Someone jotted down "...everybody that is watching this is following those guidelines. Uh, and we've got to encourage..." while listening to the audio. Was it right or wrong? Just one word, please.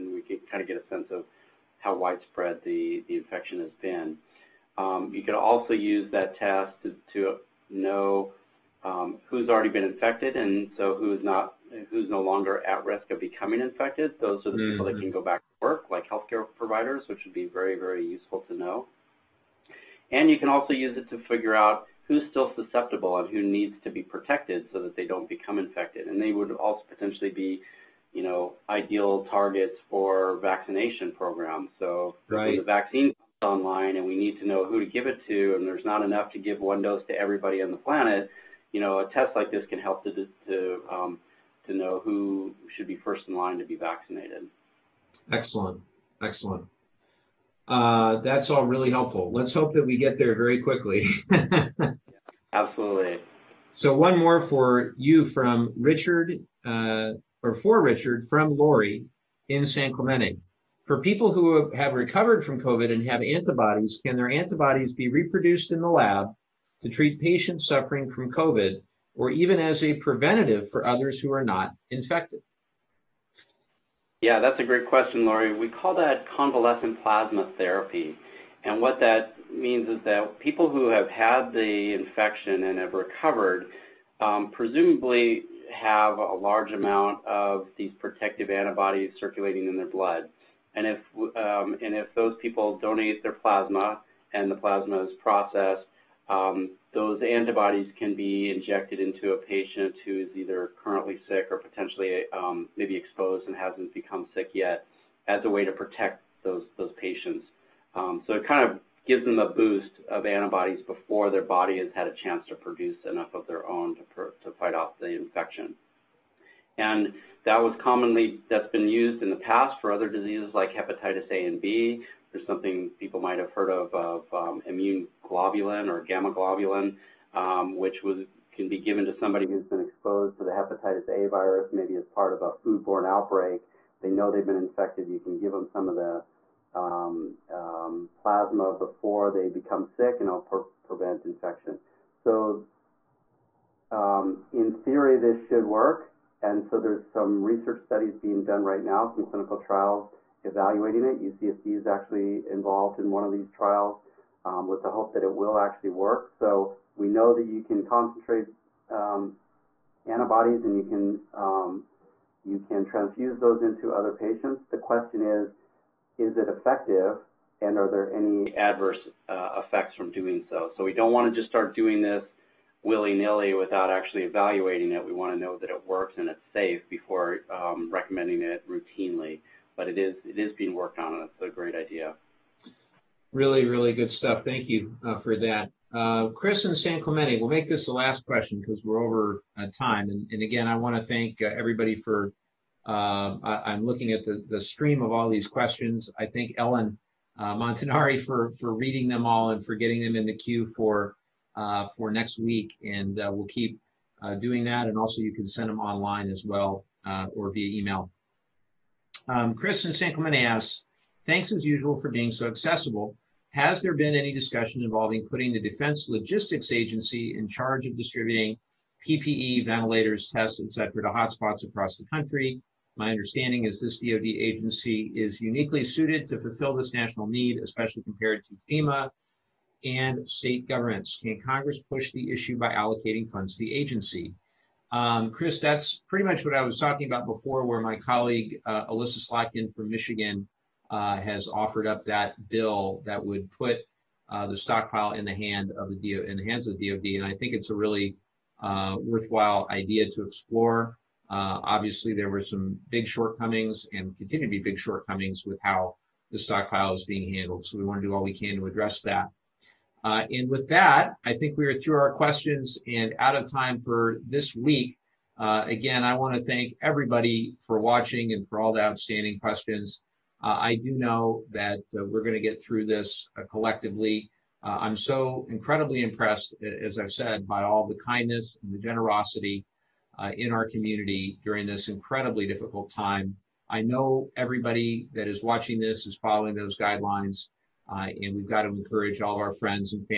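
right.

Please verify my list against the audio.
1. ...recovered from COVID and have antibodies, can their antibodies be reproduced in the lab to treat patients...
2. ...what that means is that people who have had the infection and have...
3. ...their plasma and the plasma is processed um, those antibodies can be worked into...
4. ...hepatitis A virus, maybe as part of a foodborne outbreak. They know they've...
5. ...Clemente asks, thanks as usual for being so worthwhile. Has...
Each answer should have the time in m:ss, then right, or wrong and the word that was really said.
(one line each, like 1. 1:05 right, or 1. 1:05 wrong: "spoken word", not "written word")
1. 1:01 right
2. 1:18 right
3. 1:33 wrong: "injected", not "worked"
4. 2:10 right
5. 3:30 wrong: "accessible", not "worthwhile".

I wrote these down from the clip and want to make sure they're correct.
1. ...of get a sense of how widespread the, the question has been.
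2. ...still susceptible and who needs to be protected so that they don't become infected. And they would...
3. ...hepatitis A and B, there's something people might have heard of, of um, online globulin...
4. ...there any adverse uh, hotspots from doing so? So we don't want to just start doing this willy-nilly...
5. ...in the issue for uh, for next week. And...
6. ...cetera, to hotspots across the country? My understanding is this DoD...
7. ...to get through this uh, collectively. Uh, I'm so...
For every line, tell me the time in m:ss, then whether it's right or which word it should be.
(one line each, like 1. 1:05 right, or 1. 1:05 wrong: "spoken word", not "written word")
1. 0:00 wrong: "infection", not "question"
2. 0:22 right
3. 2:00 wrong: "immune", not "online"
4. 2:47 wrong: "effects", not "hotspots"
5. 3:20 wrong: "queue", not "issue"
6. 3:40 right
7. 4:32 right.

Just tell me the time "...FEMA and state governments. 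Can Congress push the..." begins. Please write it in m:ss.
3:48.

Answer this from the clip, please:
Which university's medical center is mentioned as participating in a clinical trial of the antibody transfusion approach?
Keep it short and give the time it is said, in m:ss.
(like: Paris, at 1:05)
UCSD, at 2:31.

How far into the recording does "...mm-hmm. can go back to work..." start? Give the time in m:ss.
0:14.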